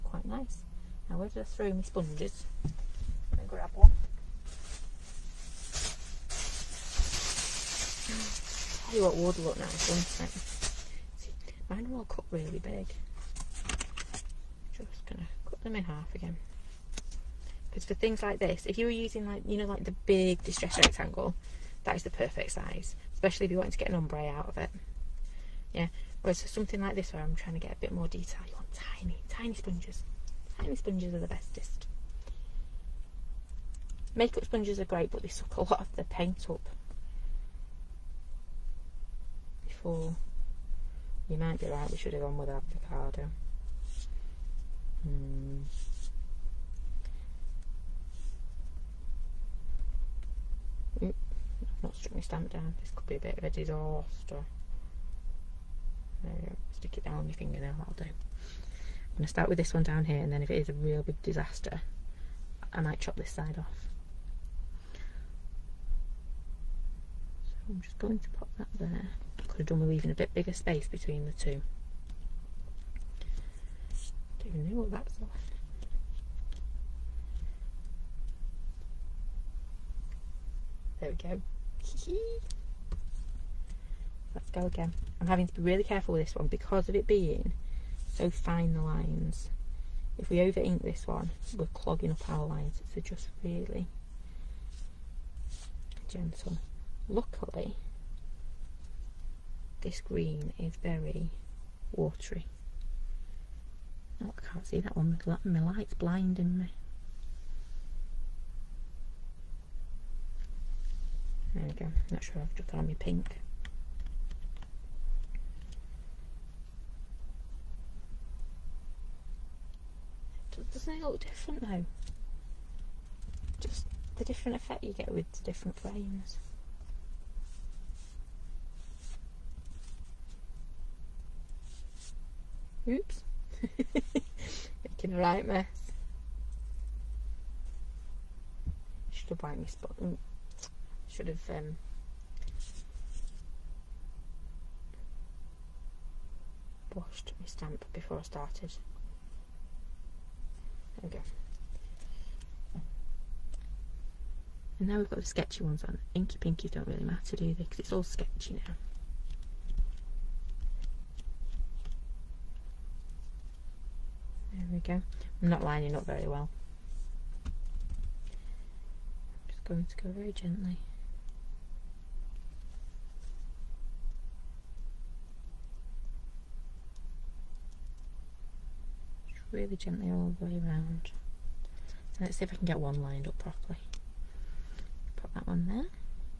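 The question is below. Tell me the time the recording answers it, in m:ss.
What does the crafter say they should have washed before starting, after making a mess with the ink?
2:27.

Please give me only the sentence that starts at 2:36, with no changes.
Inky pinkies don't really matter do they because it's all sketchy now.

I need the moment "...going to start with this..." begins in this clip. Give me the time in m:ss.
0:59.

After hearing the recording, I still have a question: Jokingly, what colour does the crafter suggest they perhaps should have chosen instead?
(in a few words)
Avocado.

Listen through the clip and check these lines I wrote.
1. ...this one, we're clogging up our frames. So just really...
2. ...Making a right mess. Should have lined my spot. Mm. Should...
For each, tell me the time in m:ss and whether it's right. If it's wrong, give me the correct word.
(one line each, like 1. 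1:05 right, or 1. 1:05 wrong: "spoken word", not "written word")
1. 1:30 wrong: "lines", not "frames"
2. 2:14 wrong: "wiped", not "lined".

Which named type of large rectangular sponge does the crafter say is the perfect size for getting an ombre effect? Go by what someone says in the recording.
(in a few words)
Distress rectangle.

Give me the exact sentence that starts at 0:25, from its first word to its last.
Yeah, whereas for something like this where I'm trying to get a bit more detail, you want tiny, tiny sponges.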